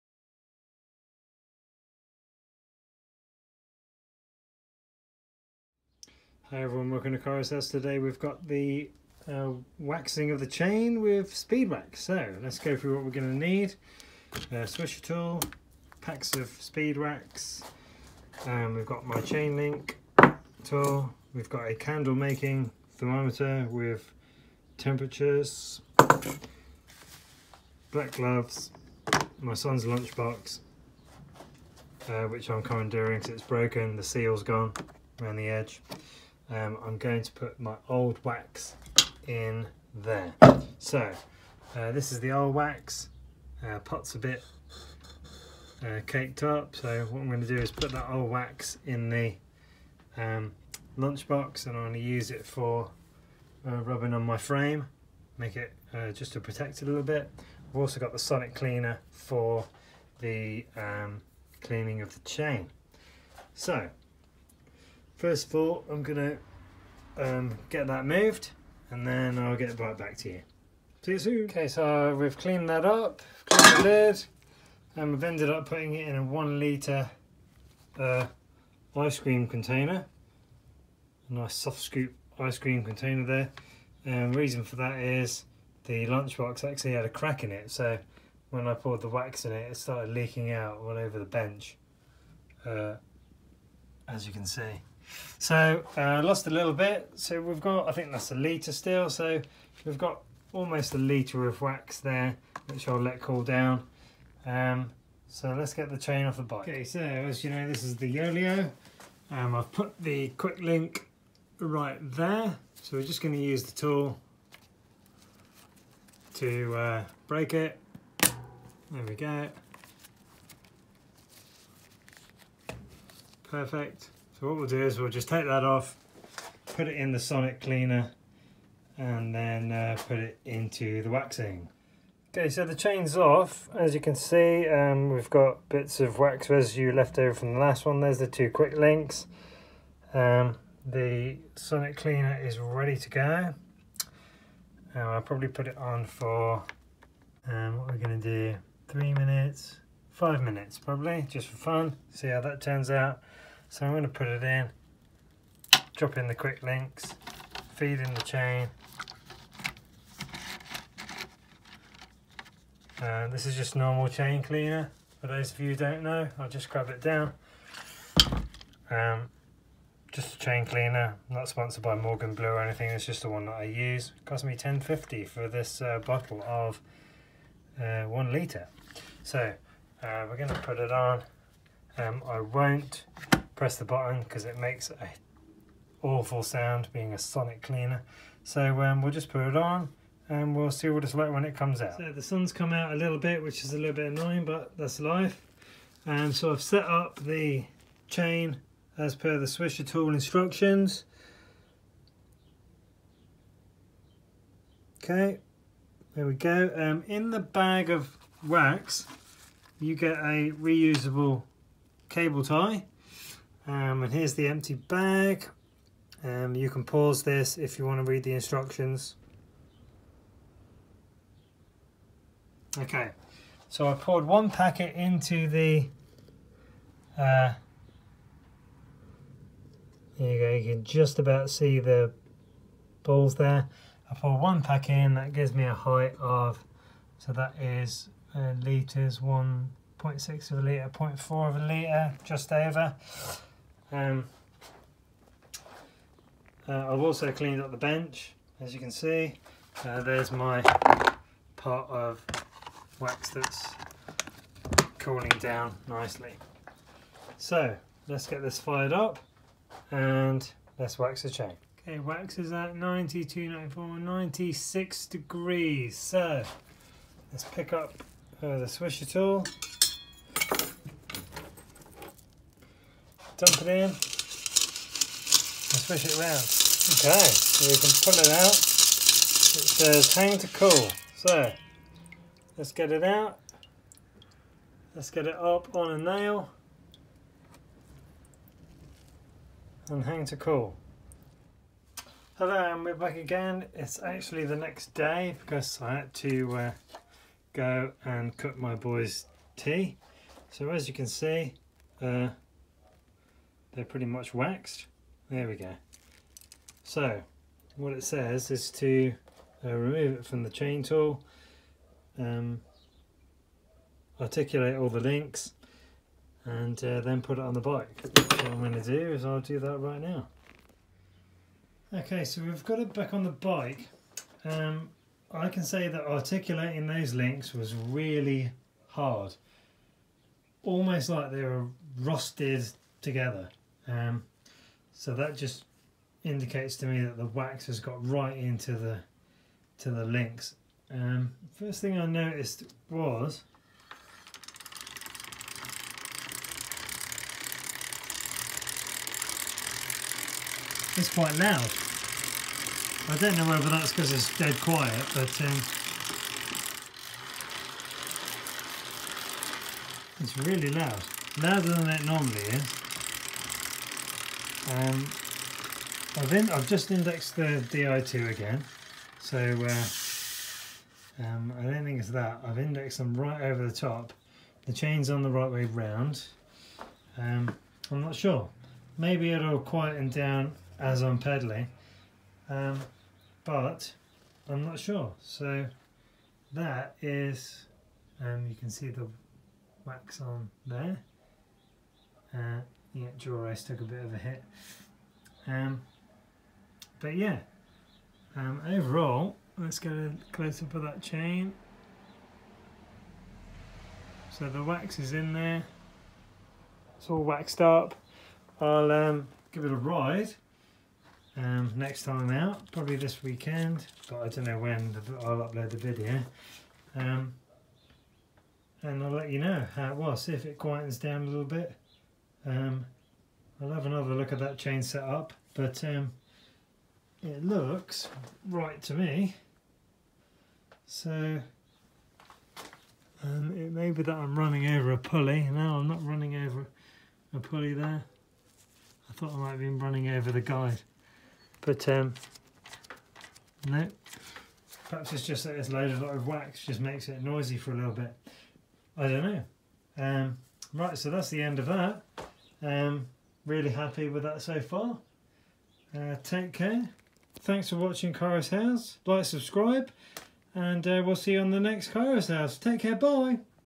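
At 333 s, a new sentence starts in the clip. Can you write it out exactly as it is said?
Um, so that just indicates to me that the wax has got right into the to the links.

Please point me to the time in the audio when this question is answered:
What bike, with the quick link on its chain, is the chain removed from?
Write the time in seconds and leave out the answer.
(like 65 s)
108 s.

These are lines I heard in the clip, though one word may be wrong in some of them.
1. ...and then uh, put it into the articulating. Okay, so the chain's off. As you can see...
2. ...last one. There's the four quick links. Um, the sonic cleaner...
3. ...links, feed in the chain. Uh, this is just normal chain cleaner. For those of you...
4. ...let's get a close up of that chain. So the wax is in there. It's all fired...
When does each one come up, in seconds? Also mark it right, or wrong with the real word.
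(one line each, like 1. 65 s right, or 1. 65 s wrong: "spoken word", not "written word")
1. 128 s wrong: "waxing", not "articulating"
2. 137 s wrong: "two", not "four"
3. 156 s right
4. 399 s wrong: "waxed", not "fired".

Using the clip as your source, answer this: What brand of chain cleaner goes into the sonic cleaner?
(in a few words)
Morgan Blue.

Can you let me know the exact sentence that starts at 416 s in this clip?
Um, and I'll let you know how it was, see if it quietens down a little bit.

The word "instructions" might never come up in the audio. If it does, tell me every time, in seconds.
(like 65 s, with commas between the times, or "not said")
200 s, 218 s.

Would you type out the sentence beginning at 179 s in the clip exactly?
So, uh, we're going to put it on.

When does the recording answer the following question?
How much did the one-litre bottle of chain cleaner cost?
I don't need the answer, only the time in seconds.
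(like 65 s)
174 s.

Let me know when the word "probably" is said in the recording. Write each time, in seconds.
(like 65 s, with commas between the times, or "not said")
145 s, 150 s, 412 s.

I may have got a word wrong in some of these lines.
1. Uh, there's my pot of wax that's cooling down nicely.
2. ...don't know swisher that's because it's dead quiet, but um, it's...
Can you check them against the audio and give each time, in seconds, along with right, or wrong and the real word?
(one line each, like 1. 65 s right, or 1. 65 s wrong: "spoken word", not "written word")
1. 249 s right
2. 353 s wrong: "whether", not "swisher".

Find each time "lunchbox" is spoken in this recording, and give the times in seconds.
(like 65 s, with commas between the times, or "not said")
29 s, 50 s, 86 s.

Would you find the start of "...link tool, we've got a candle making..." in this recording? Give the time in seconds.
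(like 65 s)
19 s.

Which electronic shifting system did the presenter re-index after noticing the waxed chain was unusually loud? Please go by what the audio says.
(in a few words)
DI2.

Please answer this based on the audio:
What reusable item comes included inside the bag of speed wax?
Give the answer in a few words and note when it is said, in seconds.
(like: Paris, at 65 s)
Cable tie, at 212 s.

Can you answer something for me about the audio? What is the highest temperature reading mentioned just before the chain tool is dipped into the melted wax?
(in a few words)
96 degrees.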